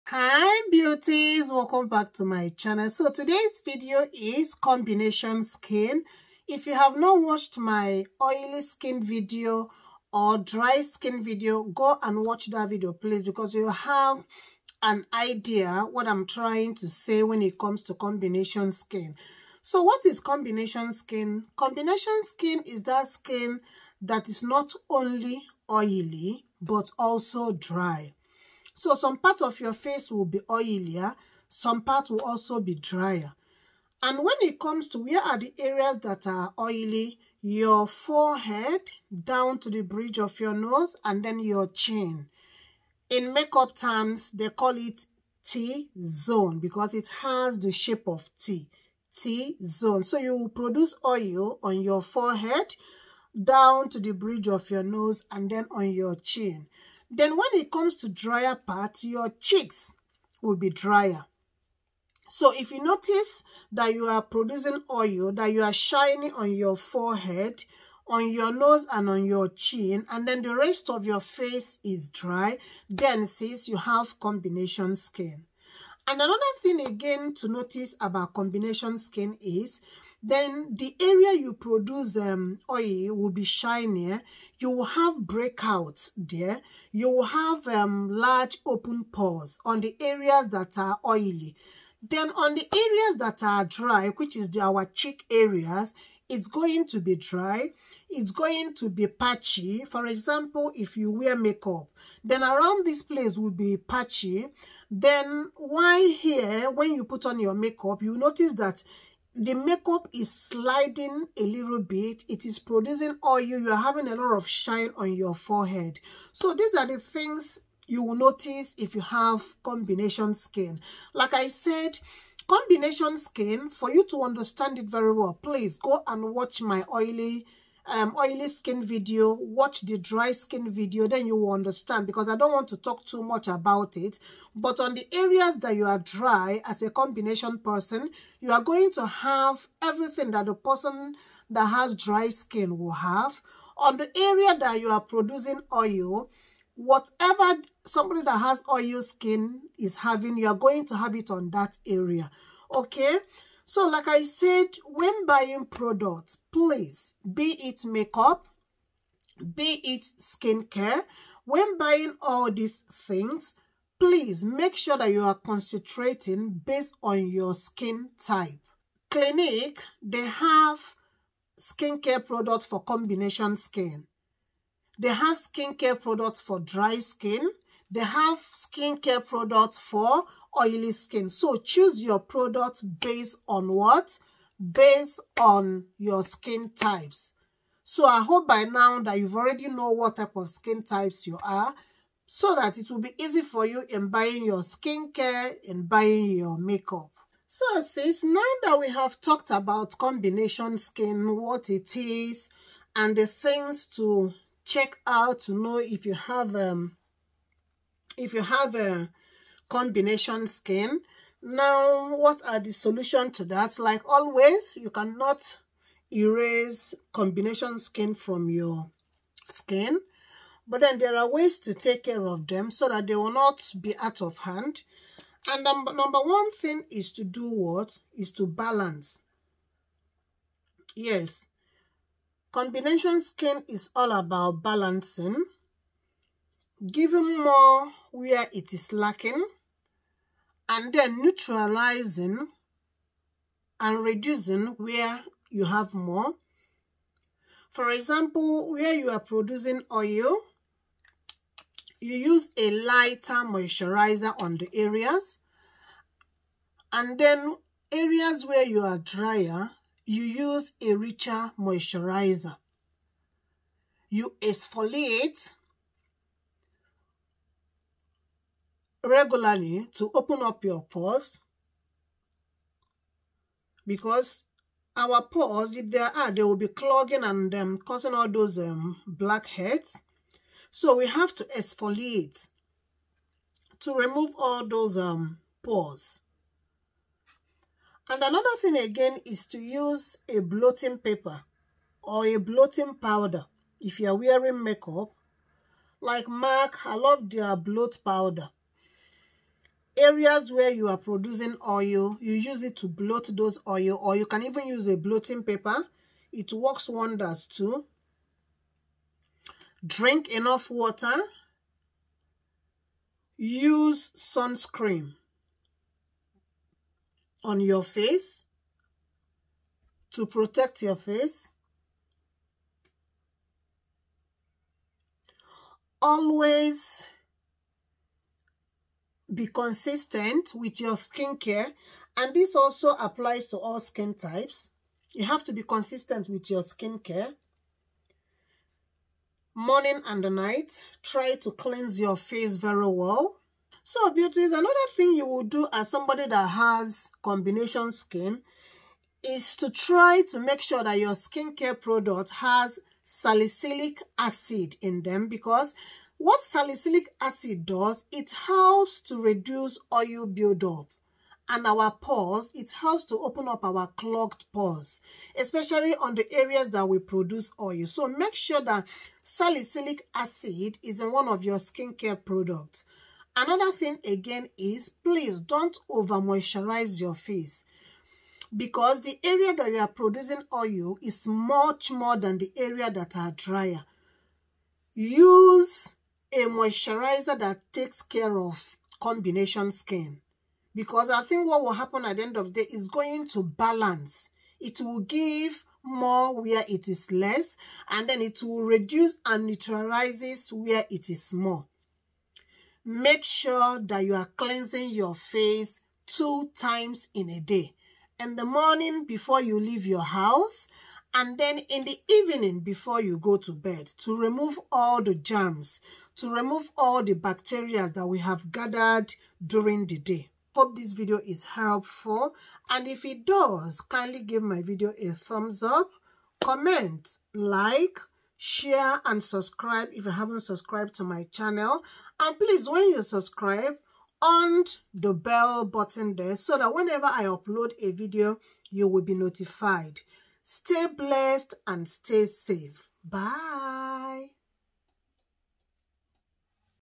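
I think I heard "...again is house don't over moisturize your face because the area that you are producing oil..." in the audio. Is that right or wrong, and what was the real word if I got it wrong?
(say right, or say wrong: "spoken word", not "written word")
wrong: "please", not "house".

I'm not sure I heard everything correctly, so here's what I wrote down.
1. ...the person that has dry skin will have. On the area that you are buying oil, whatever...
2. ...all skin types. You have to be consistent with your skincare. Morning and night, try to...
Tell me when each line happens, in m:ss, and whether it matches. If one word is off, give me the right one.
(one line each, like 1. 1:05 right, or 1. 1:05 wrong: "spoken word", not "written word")
1. 2:20 wrong: "producing", not "buying"
2. 5:33 right.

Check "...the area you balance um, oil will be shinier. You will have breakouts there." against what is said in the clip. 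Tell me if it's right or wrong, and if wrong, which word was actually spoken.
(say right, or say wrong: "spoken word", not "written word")
wrong: "produce", not "balance".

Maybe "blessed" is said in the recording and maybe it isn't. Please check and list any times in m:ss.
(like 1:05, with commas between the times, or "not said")
7:20.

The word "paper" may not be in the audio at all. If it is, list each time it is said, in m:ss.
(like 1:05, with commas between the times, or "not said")
4:50, 5:05.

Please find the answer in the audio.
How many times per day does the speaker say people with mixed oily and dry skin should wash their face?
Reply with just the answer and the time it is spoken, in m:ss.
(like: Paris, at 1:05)
2, at 6:46.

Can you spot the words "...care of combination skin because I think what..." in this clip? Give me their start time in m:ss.
6:28.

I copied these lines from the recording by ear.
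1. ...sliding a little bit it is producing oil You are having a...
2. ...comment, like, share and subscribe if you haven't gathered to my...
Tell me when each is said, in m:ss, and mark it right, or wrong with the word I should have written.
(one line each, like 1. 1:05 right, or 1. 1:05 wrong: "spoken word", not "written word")
1. 1:50 right
2. 7:06 wrong: "subscribed", not "gathered".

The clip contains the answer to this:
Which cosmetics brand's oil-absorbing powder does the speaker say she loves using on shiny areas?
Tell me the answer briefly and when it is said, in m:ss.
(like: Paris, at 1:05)
MAC, at 4:56.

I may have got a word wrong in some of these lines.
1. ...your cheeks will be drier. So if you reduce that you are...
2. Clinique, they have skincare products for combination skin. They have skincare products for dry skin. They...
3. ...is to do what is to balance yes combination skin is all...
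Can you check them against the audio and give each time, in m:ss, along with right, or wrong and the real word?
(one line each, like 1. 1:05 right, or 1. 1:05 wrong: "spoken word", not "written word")
1. 0:59 wrong: "notice", not "reduce"
2. 2:49 right
3. 3:46 right.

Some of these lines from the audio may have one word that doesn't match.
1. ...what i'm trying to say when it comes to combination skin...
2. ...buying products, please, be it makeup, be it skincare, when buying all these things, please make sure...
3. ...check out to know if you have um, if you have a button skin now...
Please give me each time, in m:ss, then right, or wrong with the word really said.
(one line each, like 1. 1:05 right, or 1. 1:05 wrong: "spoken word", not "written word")
1. 0:15 right
2. 2:35 right
3. 3:24 wrong: "combination", not "button".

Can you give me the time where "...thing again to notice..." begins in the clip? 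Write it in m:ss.
1:16.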